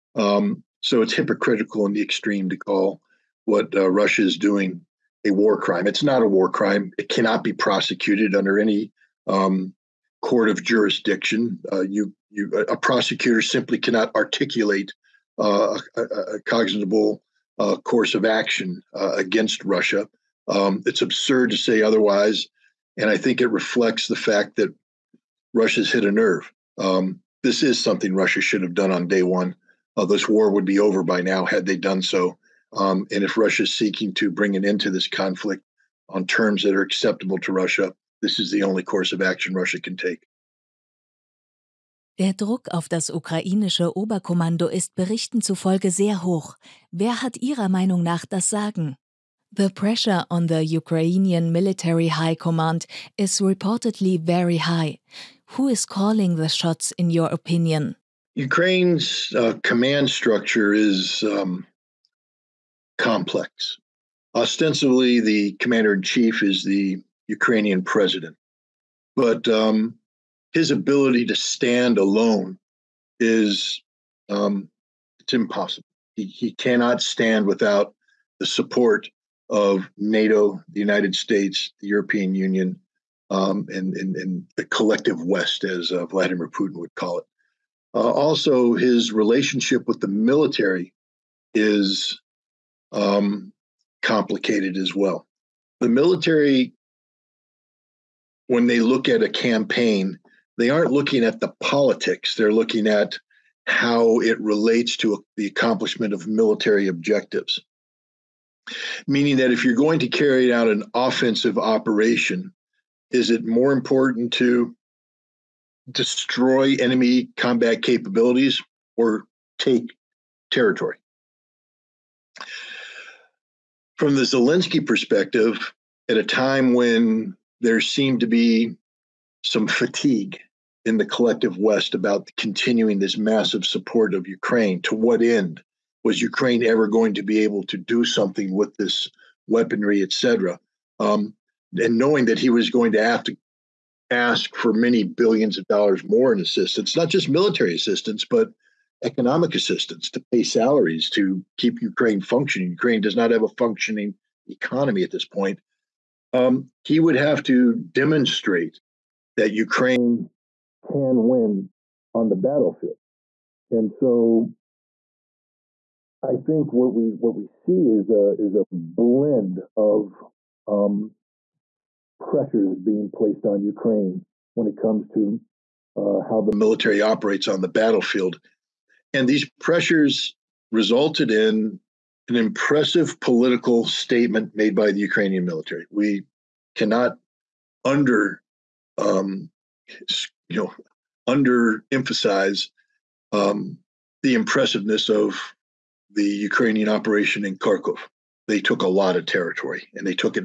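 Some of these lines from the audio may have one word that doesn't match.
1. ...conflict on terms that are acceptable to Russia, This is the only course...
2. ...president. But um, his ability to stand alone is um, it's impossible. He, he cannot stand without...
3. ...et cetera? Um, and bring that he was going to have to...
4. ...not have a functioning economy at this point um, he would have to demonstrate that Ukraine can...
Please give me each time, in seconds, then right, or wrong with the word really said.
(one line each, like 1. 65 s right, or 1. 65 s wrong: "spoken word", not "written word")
1. 35 s right
2. 67 s right
3. 140 s wrong: "knowing", not "bring"
4. 153 s right.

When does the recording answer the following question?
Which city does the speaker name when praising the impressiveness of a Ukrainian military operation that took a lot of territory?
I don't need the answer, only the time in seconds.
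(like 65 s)
197 s.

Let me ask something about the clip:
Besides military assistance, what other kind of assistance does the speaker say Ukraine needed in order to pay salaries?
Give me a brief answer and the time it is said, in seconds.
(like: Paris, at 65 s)
Economic assistance, at 149 s.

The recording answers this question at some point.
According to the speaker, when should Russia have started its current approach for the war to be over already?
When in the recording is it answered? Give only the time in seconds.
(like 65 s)
29 s.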